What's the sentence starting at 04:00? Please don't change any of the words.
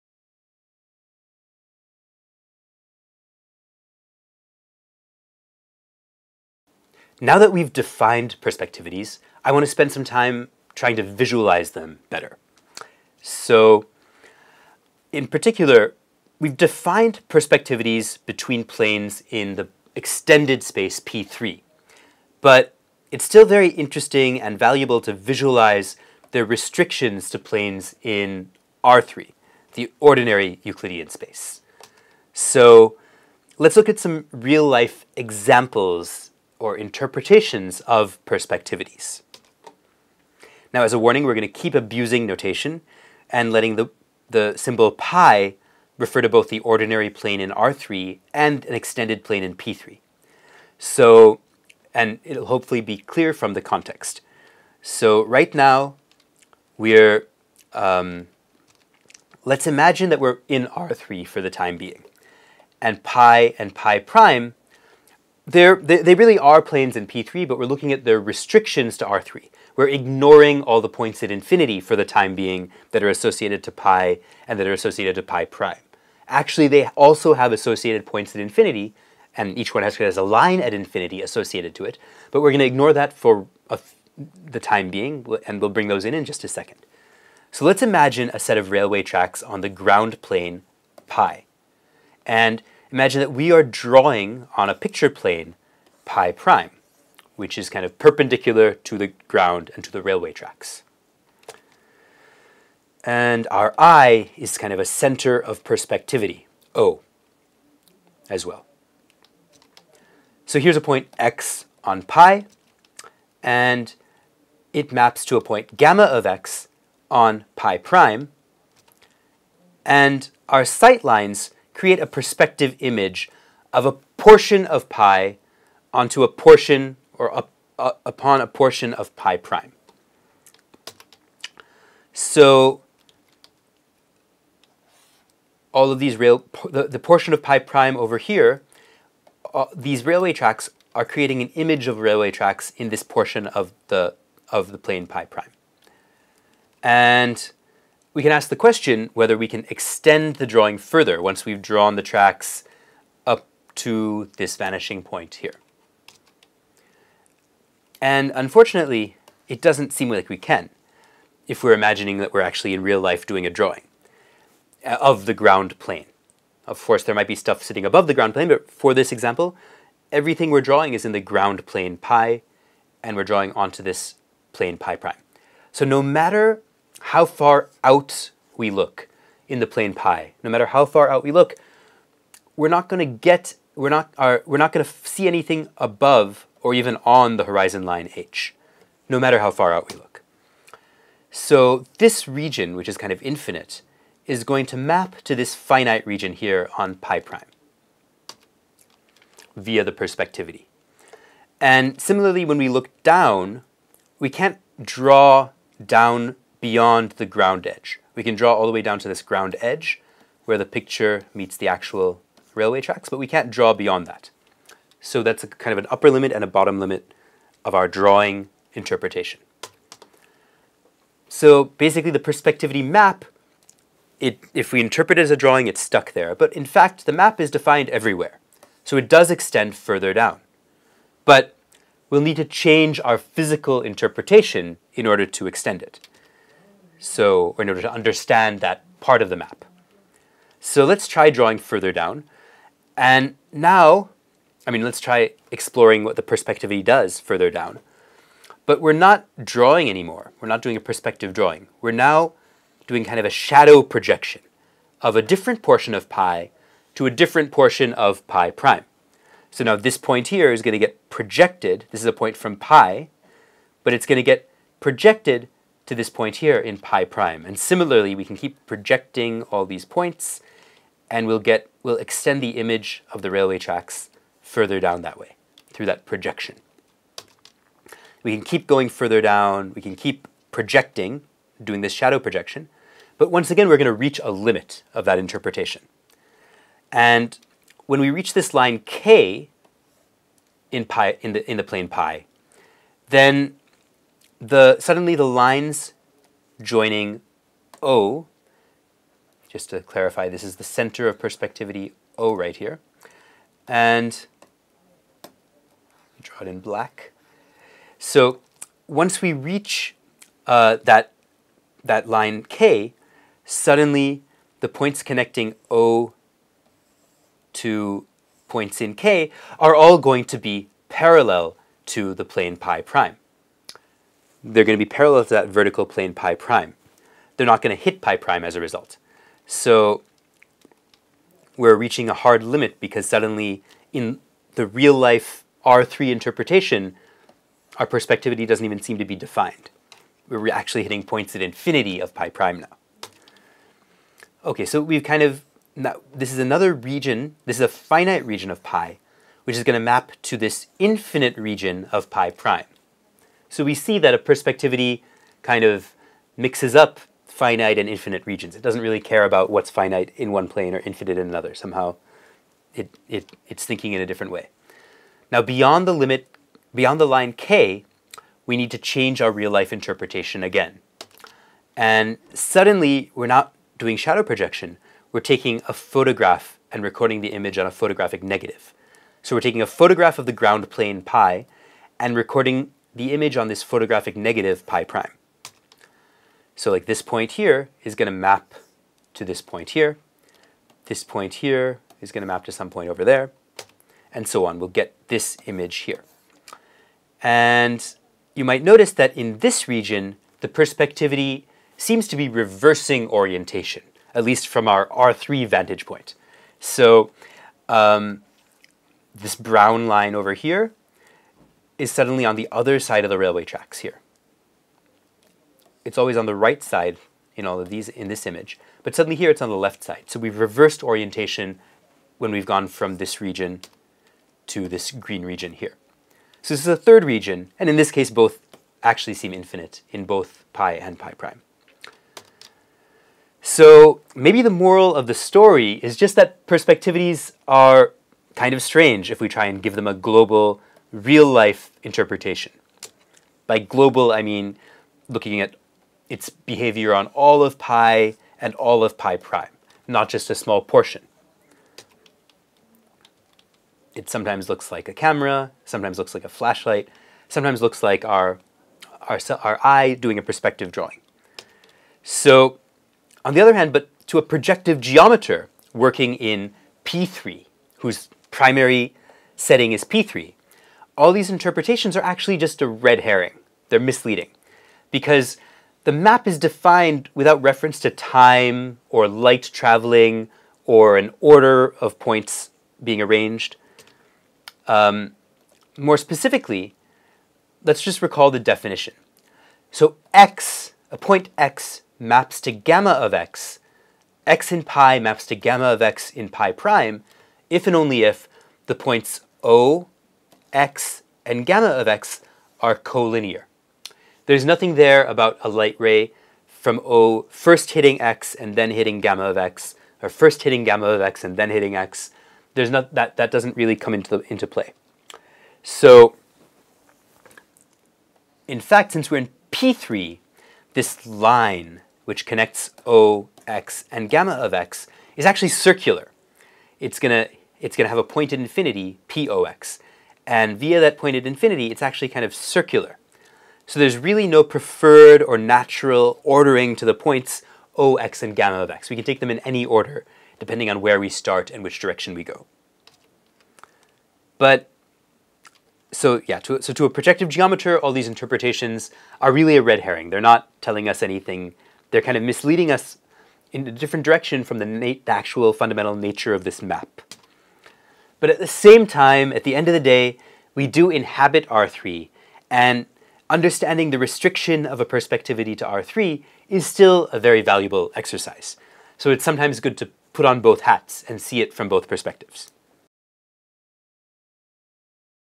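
So let's try drawing further down.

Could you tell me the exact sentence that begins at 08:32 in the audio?
There's not that that doesn't really come into the, into play.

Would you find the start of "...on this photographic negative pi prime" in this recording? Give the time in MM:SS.
06:23.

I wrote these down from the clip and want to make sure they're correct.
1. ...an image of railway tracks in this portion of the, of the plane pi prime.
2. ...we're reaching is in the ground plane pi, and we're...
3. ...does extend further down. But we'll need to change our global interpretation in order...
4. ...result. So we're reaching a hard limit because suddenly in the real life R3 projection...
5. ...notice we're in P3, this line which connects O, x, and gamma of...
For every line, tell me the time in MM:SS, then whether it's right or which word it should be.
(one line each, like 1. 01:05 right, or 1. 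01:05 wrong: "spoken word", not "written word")
1. 02:21 right
2. 02:50 wrong: "drawing", not "reaching"
3. 03:49 wrong: "physical", not "global"
4. 05:28 wrong: "interpretation", not "projection"
5. 08:38 wrong: "since", not "notice".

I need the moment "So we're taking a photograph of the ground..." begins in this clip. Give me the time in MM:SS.
06:19.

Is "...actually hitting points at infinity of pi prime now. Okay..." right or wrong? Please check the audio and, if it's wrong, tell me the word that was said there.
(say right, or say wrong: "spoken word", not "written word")
right.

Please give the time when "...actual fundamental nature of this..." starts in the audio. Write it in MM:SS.
09:15.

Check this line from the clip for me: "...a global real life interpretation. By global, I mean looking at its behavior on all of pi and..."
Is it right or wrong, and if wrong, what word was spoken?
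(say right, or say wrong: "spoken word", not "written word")
right.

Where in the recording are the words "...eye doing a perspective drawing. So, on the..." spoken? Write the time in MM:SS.
07:39.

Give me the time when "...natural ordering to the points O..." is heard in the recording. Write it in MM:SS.
08:55.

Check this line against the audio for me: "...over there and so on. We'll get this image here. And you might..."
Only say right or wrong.
right.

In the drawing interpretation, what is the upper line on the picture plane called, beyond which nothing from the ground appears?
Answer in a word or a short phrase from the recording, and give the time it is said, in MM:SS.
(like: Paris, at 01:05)
horizon line h, at 03:07.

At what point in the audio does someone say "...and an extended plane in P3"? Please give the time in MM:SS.
00:48.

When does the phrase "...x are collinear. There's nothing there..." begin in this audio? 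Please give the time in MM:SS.
08:21.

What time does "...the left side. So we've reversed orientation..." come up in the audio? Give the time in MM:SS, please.
06:59.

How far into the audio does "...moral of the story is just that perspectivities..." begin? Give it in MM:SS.
07:14.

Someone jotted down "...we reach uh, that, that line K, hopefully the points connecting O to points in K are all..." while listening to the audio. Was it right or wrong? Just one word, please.
wrong.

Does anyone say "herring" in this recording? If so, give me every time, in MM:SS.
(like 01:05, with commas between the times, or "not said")
07:53, 09:09.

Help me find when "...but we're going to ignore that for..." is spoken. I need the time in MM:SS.
01:22.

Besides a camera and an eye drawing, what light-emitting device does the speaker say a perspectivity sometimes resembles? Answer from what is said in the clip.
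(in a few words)
flashlight.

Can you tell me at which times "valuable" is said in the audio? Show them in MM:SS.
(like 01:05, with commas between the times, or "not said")
00:24, 09:27.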